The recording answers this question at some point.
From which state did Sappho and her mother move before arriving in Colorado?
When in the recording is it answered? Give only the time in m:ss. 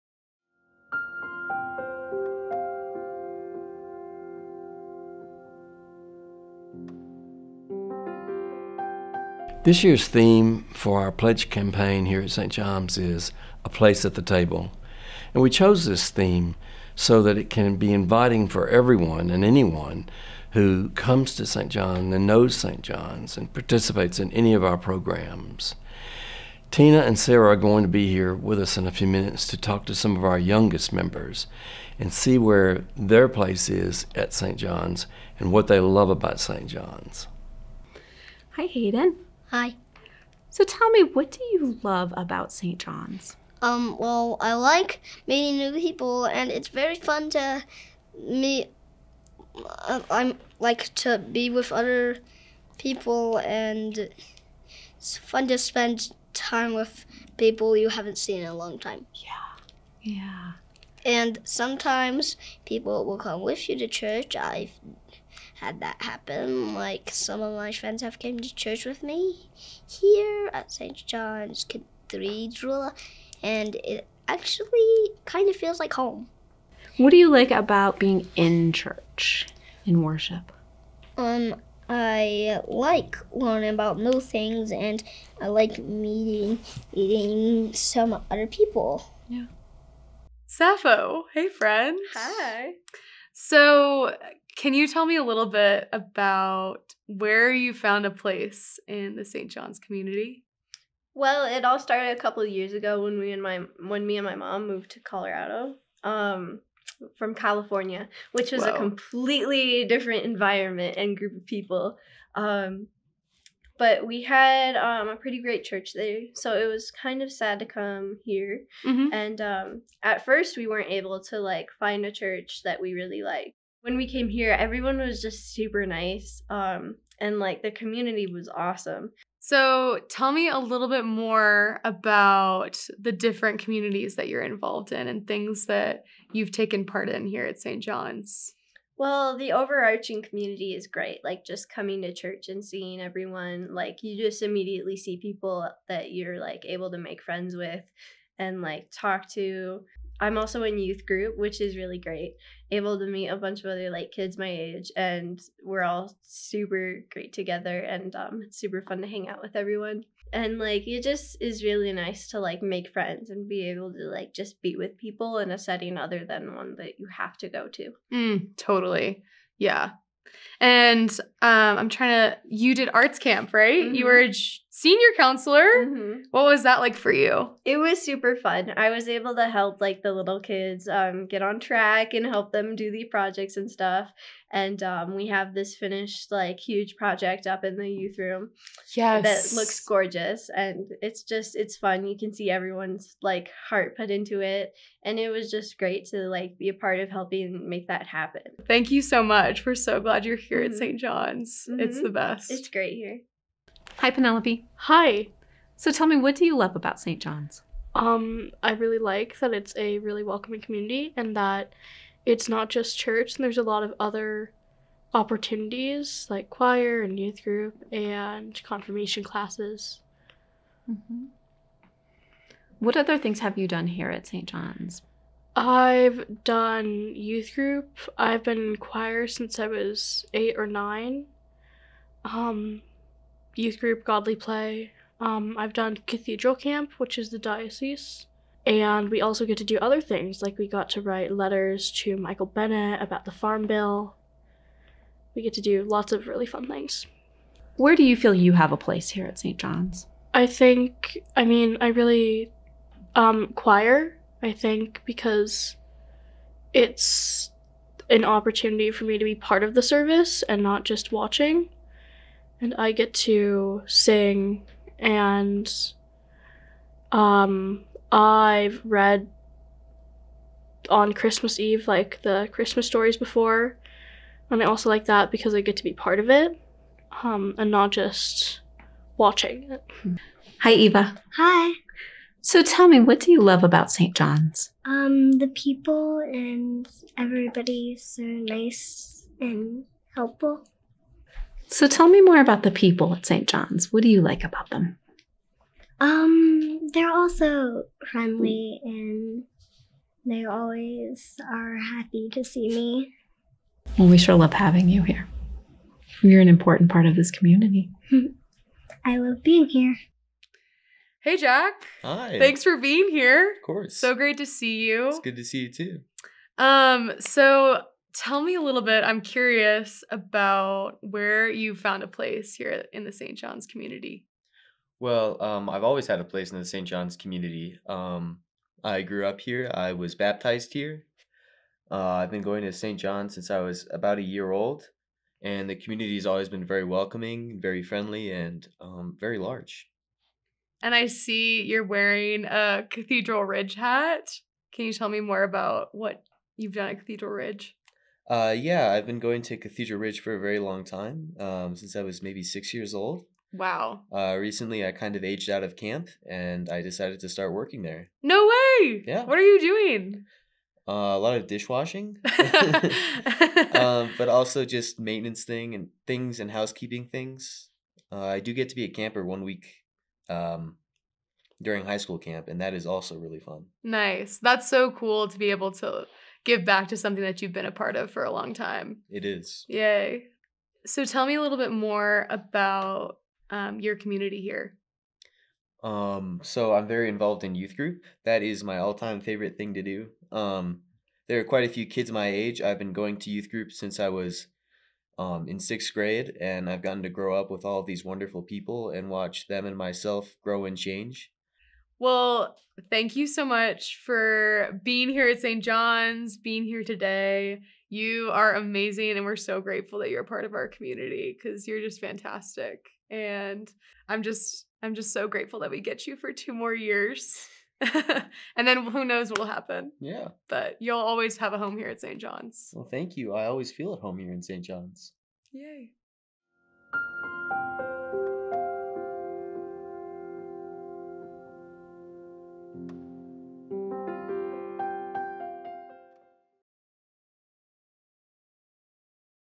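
1:47.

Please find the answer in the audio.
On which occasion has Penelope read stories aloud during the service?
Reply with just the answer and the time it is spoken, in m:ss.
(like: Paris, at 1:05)
Christmas Eve, at 4:31.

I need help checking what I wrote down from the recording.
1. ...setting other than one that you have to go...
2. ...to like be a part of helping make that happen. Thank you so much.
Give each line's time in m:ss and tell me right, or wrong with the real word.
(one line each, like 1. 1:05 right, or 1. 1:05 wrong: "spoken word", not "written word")
1. 2:45 right
2. 3:16 right.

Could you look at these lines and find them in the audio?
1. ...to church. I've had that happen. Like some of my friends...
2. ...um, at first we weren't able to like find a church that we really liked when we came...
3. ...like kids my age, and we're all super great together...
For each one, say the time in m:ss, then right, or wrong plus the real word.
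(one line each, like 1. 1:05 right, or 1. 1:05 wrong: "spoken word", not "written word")
1. 1:03 right
2. 1:59 right
3. 2:33 right.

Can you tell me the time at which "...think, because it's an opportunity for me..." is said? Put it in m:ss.
4:14.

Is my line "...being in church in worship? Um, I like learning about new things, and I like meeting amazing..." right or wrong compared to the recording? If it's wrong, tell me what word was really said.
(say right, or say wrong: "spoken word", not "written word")
wrong: "meeting", not "amazing".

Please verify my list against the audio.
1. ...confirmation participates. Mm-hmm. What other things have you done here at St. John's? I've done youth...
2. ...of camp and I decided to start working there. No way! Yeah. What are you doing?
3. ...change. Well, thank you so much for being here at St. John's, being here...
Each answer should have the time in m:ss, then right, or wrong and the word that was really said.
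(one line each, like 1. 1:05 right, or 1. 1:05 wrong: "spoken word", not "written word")
1. 3:38 wrong: "classes", not "participates"
2. 5:55 right
3. 6:40 right.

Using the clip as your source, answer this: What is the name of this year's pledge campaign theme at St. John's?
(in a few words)
A Place at the Table.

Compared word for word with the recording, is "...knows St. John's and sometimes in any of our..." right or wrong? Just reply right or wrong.
wrong.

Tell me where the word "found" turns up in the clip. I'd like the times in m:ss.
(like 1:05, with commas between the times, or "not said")
1:37, 5:21.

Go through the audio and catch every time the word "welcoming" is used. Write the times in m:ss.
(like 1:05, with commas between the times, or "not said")
3:30, 5:36.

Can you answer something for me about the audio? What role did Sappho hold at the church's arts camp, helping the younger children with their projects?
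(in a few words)
Senior counselor.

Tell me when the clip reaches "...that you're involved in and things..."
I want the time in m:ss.
2:14.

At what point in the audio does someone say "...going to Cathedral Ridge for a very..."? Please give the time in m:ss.
5:49.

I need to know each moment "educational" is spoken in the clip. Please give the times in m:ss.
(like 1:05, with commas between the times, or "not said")
not said.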